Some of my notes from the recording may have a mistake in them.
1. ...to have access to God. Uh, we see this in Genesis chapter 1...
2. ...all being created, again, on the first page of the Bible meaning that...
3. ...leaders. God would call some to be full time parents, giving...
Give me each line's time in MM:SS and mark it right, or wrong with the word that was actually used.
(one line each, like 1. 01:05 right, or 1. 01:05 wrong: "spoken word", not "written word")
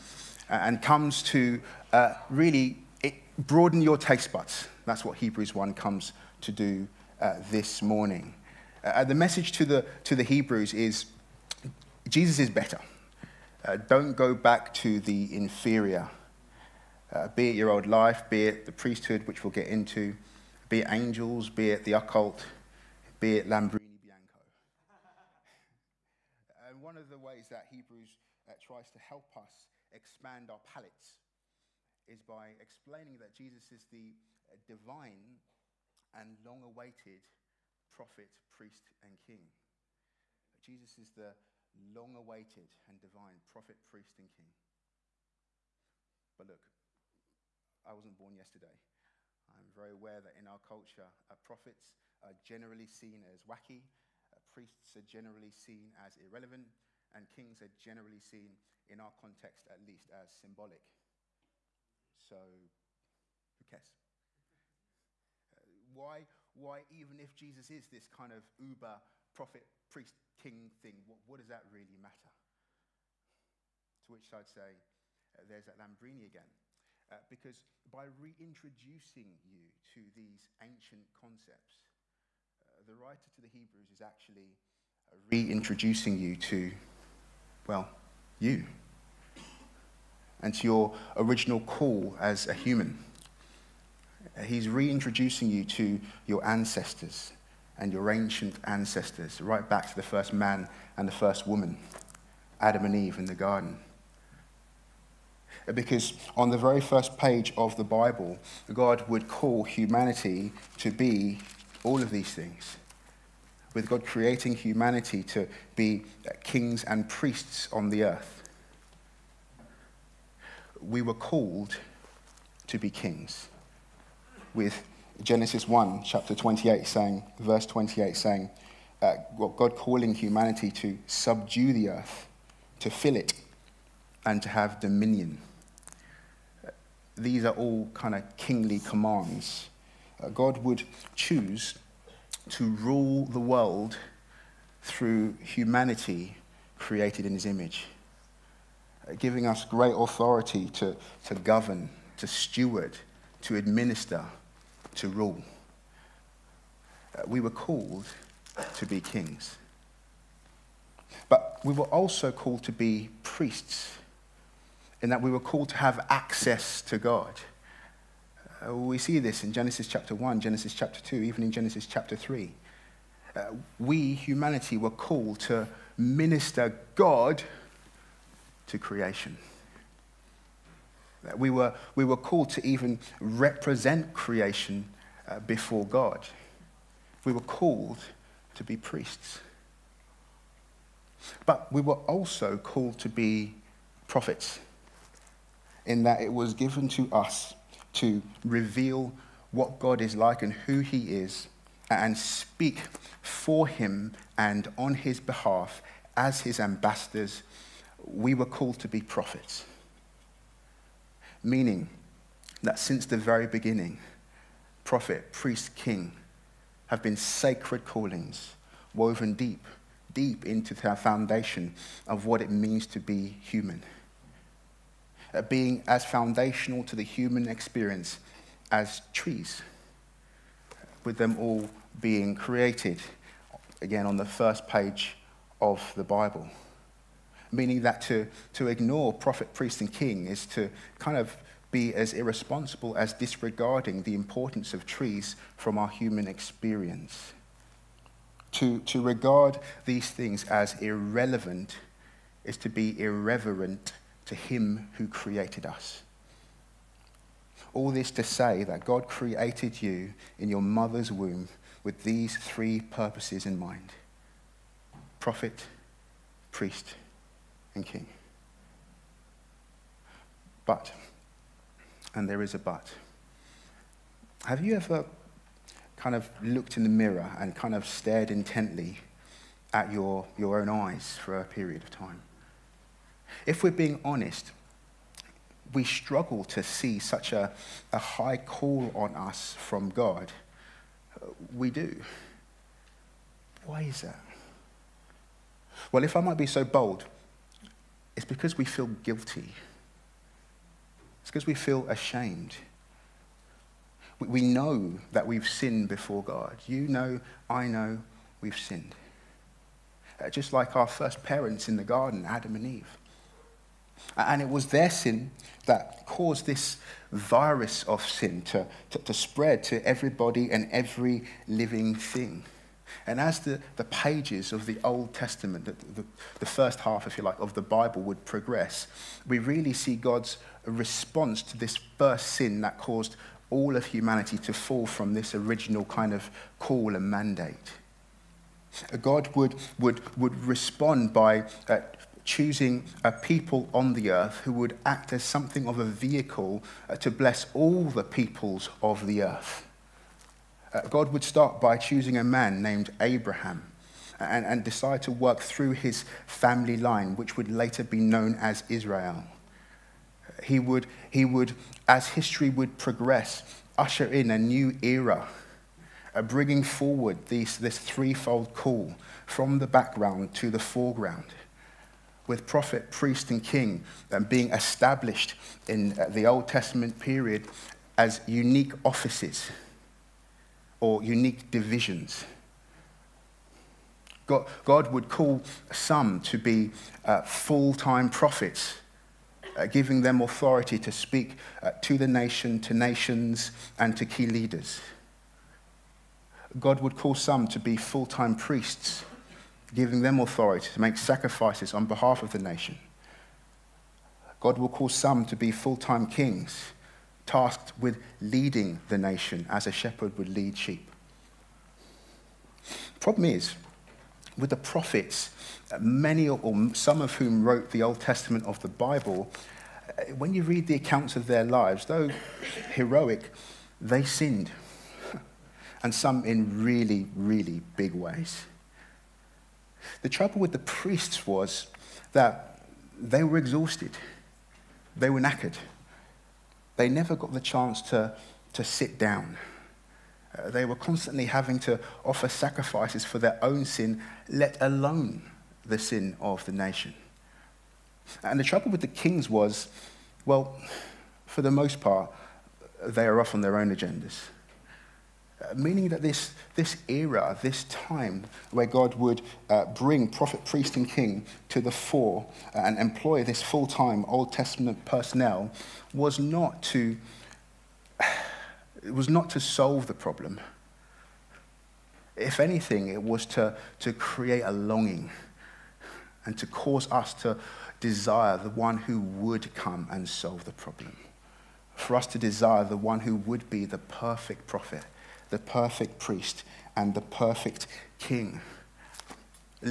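1. 02:45 right
2. 03:51 right
3. 06:34 wrong: "priests", not "parents".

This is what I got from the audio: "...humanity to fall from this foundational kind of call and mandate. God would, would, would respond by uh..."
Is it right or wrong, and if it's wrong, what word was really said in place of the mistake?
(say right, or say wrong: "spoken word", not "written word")
wrong: "original", not "foundational".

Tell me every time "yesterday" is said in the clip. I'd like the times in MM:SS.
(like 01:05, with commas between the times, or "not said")
00:48.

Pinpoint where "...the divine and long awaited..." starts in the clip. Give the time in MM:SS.
00:33.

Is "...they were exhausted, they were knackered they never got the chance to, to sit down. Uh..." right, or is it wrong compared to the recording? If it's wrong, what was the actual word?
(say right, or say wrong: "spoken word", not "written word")
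right.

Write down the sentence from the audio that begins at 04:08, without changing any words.
To, to regard these things as irrelevant is to be irreverent to Him who created us.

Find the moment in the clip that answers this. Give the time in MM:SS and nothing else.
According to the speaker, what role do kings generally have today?
01:00.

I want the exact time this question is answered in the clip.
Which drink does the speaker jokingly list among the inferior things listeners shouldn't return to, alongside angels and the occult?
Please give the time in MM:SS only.
00:23.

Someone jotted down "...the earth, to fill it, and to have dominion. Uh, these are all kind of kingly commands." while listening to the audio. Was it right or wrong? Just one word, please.
right.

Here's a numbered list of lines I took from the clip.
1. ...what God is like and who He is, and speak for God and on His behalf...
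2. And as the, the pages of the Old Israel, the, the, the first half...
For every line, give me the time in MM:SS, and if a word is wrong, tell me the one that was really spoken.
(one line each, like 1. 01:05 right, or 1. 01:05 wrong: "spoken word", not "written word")
1. 03:19 wrong: "Him", not "God"
2. 05:23 wrong: "Testament", not "Israel".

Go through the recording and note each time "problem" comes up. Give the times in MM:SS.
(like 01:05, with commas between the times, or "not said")
06:53, 07:49, 08:00.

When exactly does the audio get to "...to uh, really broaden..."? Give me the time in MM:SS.
00:01.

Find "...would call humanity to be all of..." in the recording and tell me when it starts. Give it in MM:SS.
01:49.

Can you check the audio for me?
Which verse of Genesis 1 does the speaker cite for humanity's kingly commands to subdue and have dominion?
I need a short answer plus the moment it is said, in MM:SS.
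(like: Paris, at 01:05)
verse 28, at 02:07.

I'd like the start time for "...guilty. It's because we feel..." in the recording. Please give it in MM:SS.
04:59.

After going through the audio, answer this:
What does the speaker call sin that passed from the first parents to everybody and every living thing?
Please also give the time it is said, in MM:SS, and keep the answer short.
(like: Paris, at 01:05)
virus of sin, at 05:17.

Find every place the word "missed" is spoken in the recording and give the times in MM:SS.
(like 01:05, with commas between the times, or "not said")
not said.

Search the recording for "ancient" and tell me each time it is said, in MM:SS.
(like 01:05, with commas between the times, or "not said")
01:20, 01:38.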